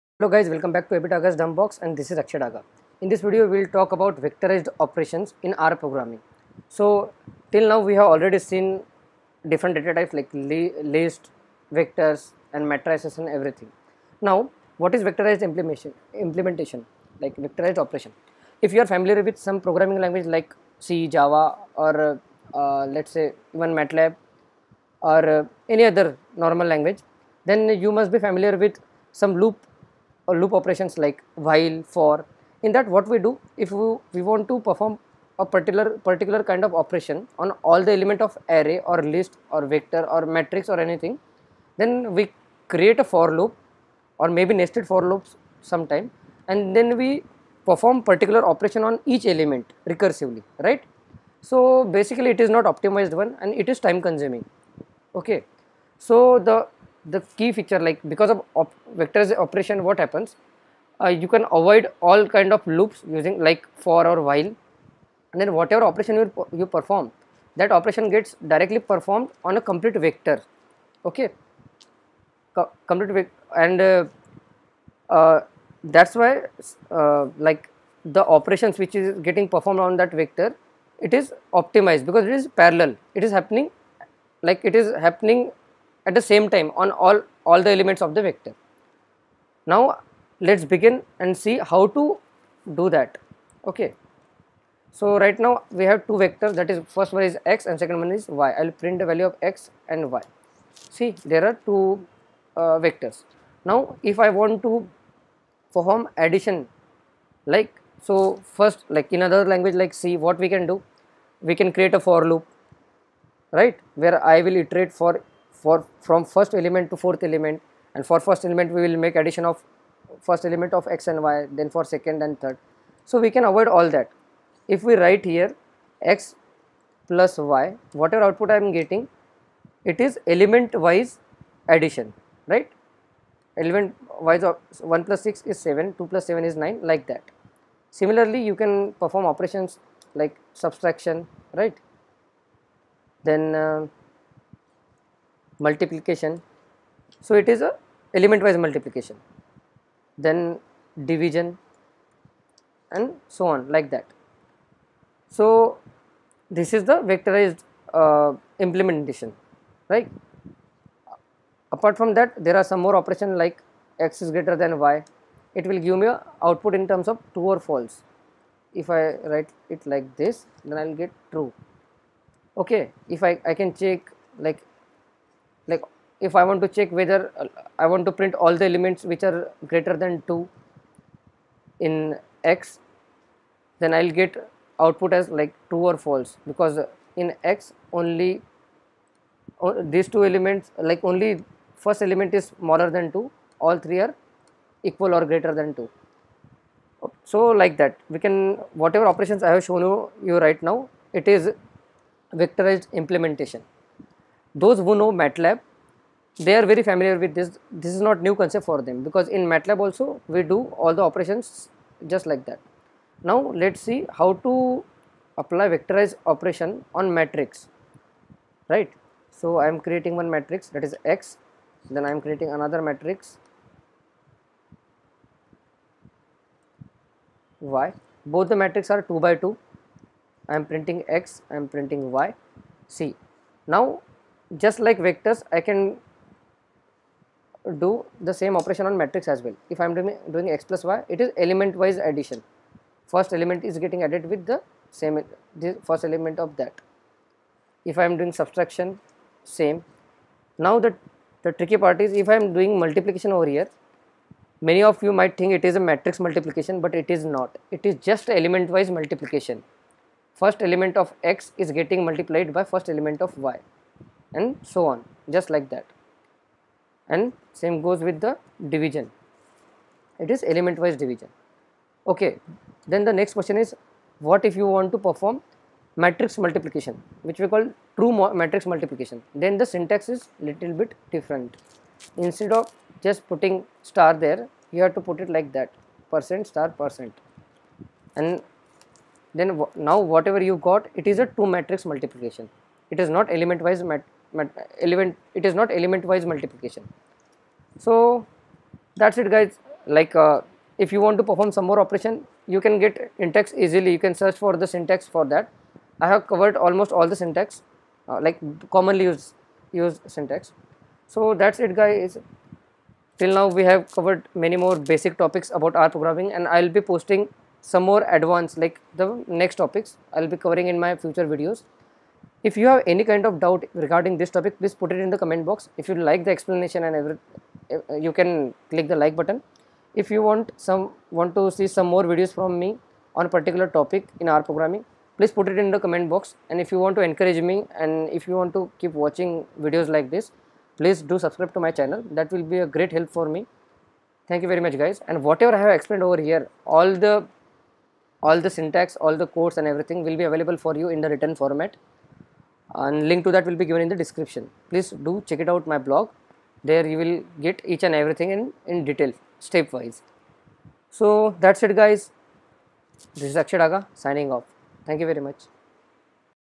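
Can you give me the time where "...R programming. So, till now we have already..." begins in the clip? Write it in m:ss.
0:05.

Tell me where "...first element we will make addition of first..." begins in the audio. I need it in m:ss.
1:58.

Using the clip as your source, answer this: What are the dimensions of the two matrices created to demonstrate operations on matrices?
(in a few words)
2 by 2.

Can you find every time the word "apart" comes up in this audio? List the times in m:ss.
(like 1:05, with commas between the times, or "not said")
2:41.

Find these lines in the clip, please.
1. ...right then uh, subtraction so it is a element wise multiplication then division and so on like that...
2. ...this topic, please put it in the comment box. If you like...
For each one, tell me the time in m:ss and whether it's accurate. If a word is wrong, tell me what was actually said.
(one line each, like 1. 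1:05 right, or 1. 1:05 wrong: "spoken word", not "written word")
1. 2:21 wrong: "multiplication", not "subtraction"
2. 5:24 right.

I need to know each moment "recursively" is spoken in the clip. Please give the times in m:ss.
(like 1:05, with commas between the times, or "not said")
0:49.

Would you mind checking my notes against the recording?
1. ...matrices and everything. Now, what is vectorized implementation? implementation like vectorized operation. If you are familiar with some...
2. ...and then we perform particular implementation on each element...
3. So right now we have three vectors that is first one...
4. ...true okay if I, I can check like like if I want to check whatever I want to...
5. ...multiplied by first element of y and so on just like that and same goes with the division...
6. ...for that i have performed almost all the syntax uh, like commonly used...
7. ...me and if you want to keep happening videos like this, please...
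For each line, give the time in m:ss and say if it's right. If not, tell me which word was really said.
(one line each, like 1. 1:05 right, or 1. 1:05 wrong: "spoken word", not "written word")
1. 0:12 right
2. 0:46 wrong: "operation", not "implementation"
3. 1:34 wrong: "two", not "three"
4. 2:51 wrong: "whether", not "whatever"
5. 4:22 right
6. 5:05 wrong: "covered", not "performed"
7. 5:37 wrong: "watching", not "happening".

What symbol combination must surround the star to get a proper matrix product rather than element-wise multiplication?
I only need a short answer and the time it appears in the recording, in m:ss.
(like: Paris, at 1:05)
percent star percent, at 4:46.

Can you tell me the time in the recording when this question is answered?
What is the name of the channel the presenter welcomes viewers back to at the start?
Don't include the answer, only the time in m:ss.
0:01.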